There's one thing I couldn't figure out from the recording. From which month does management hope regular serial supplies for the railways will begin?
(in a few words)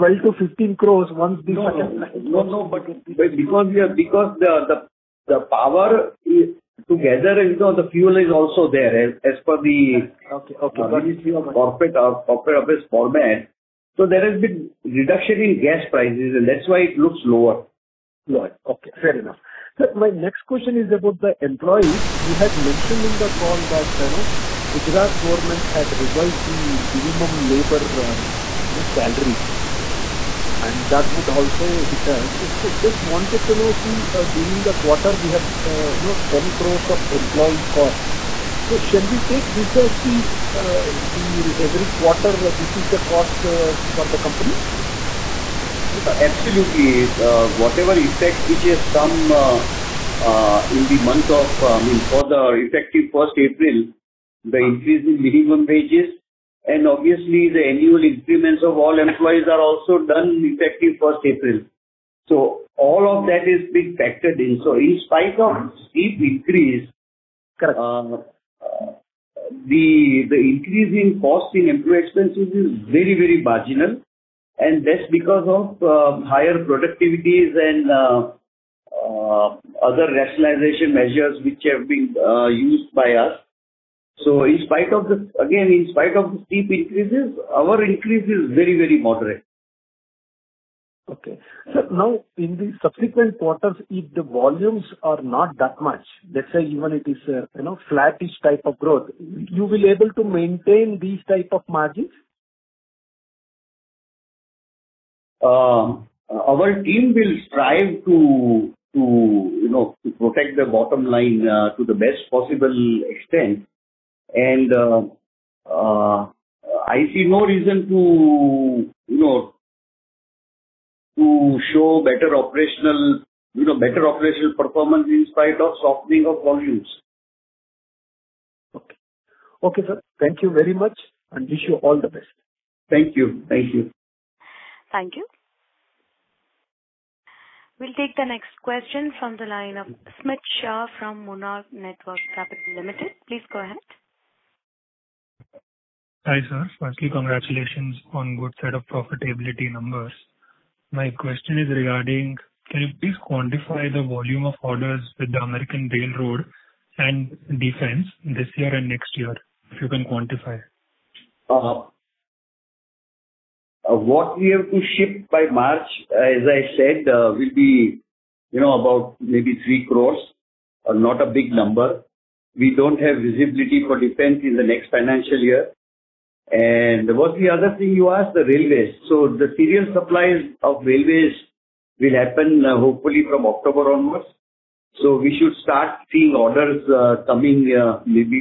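October.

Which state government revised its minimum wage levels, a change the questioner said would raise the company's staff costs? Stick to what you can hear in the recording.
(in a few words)
Gujarat.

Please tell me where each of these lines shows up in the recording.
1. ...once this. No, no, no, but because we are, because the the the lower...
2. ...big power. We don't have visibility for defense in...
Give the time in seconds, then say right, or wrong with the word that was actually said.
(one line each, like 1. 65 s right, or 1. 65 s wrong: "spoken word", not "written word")
1. 1 s wrong: "power", not "lower"
2. 171 s wrong: "number", not "power".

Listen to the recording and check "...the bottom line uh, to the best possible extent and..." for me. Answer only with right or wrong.
right.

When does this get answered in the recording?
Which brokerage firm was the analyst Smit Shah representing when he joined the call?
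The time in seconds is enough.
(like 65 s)
141 s.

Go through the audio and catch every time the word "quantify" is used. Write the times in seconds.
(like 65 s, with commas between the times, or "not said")
153 s, 160 s.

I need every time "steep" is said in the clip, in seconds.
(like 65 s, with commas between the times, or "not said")
65 s, 86 s.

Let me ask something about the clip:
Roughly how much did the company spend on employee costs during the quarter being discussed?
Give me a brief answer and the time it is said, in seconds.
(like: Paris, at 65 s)
10 crores, at 36 s.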